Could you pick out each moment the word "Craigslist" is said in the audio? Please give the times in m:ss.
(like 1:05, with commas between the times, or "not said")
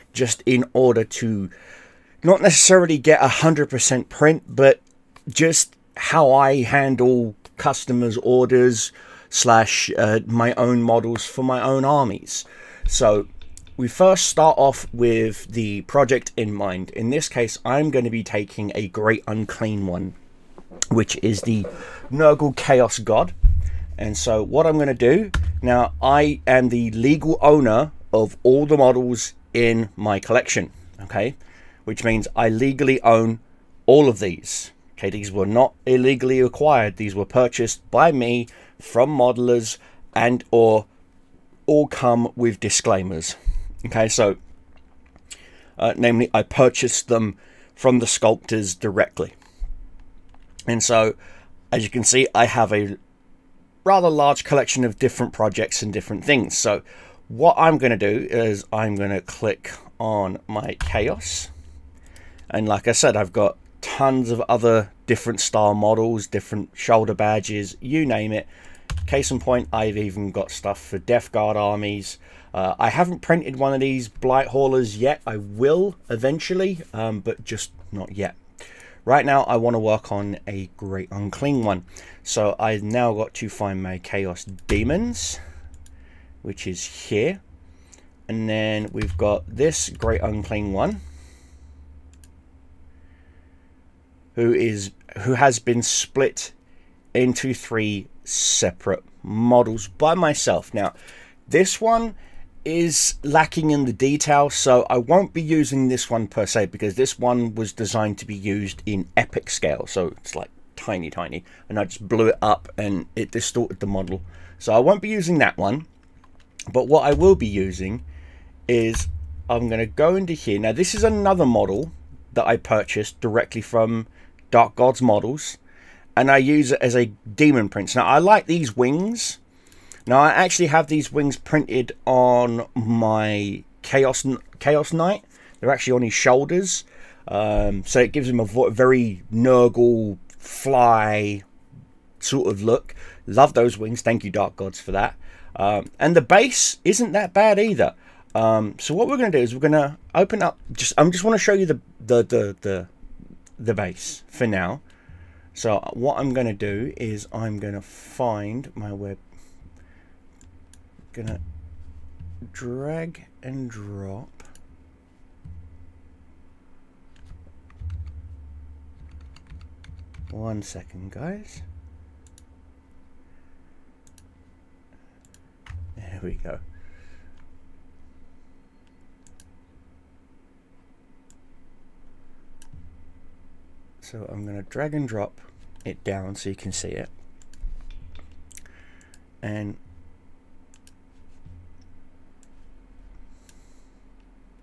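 not said.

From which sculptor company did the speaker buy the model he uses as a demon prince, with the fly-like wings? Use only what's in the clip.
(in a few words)
Dark Gods Models.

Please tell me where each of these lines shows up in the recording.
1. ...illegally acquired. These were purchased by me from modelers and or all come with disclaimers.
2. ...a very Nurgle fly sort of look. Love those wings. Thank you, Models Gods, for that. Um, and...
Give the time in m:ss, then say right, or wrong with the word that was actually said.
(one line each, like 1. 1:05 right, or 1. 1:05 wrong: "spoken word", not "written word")
1. 0:35 right
2. 2:18 wrong: "Dark", not "Models".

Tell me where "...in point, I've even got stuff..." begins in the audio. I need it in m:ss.
1:09.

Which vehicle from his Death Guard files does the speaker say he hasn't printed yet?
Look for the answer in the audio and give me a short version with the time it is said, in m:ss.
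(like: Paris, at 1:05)
Blight Haulers, at 1:14.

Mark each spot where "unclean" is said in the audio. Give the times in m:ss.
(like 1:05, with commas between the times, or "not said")
0:19, 1:21, 1:30.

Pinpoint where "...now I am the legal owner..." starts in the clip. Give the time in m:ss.
0:25.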